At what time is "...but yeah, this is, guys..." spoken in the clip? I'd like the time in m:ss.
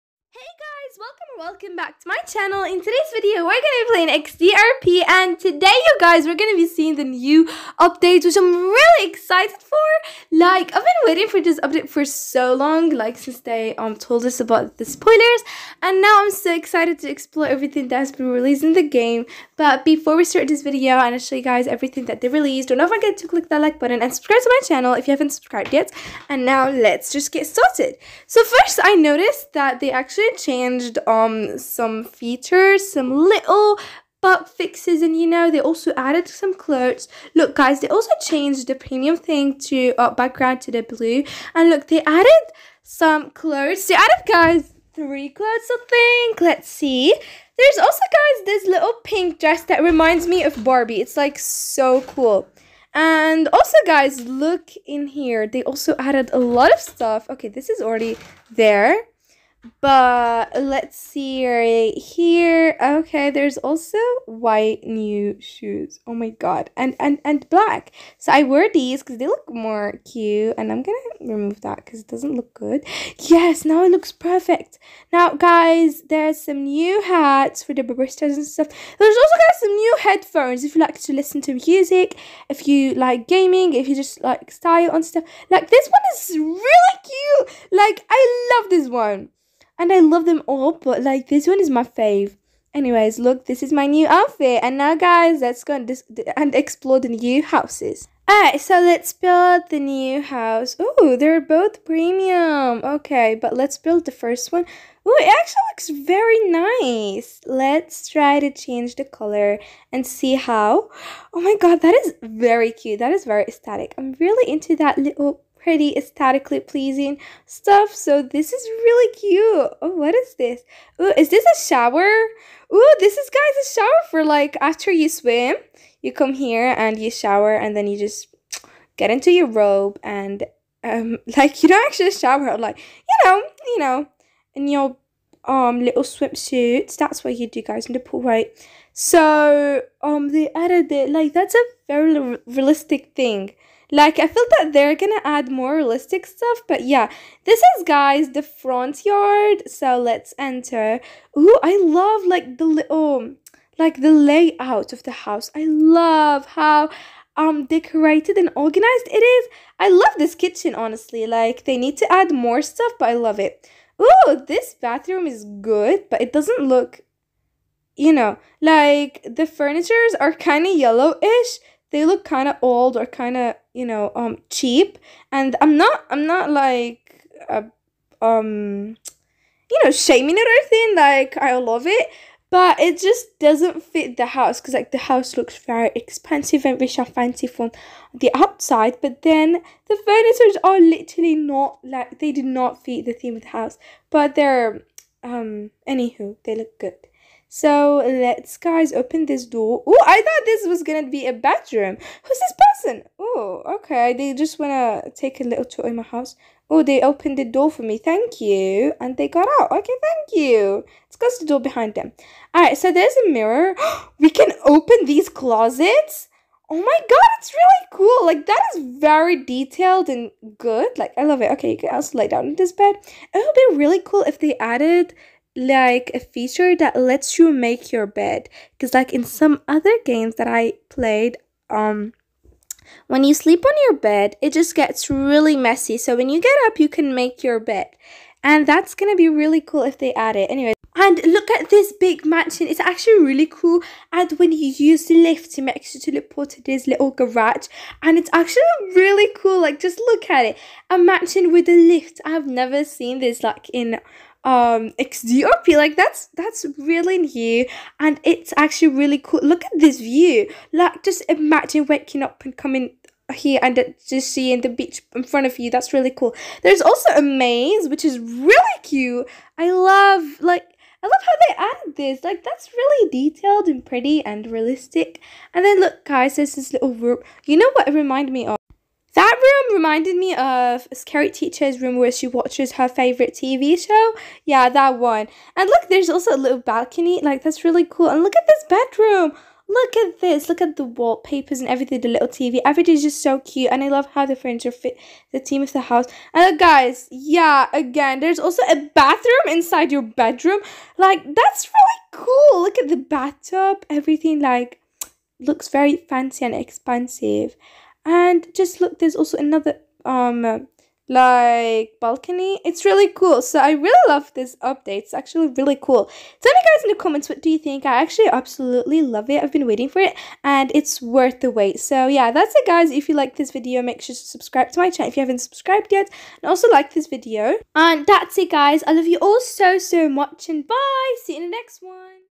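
2:26.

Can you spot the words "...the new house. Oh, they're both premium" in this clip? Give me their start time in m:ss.
1:39.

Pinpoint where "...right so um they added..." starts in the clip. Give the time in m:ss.
2:18.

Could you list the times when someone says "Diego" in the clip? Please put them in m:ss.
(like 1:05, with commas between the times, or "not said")
not said.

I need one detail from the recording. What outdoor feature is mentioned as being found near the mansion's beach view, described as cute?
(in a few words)
A maze.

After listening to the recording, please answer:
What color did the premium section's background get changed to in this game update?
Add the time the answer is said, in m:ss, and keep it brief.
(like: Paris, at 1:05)
Blue, at 0:40.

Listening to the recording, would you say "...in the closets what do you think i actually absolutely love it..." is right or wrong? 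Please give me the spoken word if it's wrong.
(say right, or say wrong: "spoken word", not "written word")
wrong: "comments", not "closets".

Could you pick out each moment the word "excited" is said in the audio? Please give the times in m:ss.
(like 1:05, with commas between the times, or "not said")
0:09, 0:16.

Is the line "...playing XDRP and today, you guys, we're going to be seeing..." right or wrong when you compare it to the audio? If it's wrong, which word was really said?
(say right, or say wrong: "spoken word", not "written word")
right.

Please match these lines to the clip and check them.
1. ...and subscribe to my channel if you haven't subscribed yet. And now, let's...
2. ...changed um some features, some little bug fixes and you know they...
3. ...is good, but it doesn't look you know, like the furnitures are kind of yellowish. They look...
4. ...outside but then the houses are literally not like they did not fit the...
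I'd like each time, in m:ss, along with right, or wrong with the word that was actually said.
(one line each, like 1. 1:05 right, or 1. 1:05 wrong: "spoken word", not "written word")
1. 0:24 right
2. 0:30 right
3. 2:45 right
4. 3:08 wrong: "furnitures", not "houses".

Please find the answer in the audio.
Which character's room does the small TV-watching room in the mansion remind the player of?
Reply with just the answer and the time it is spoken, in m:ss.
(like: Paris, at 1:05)
Scary Teacher, at 4:40.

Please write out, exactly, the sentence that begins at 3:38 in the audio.
Like that is very detailed and good.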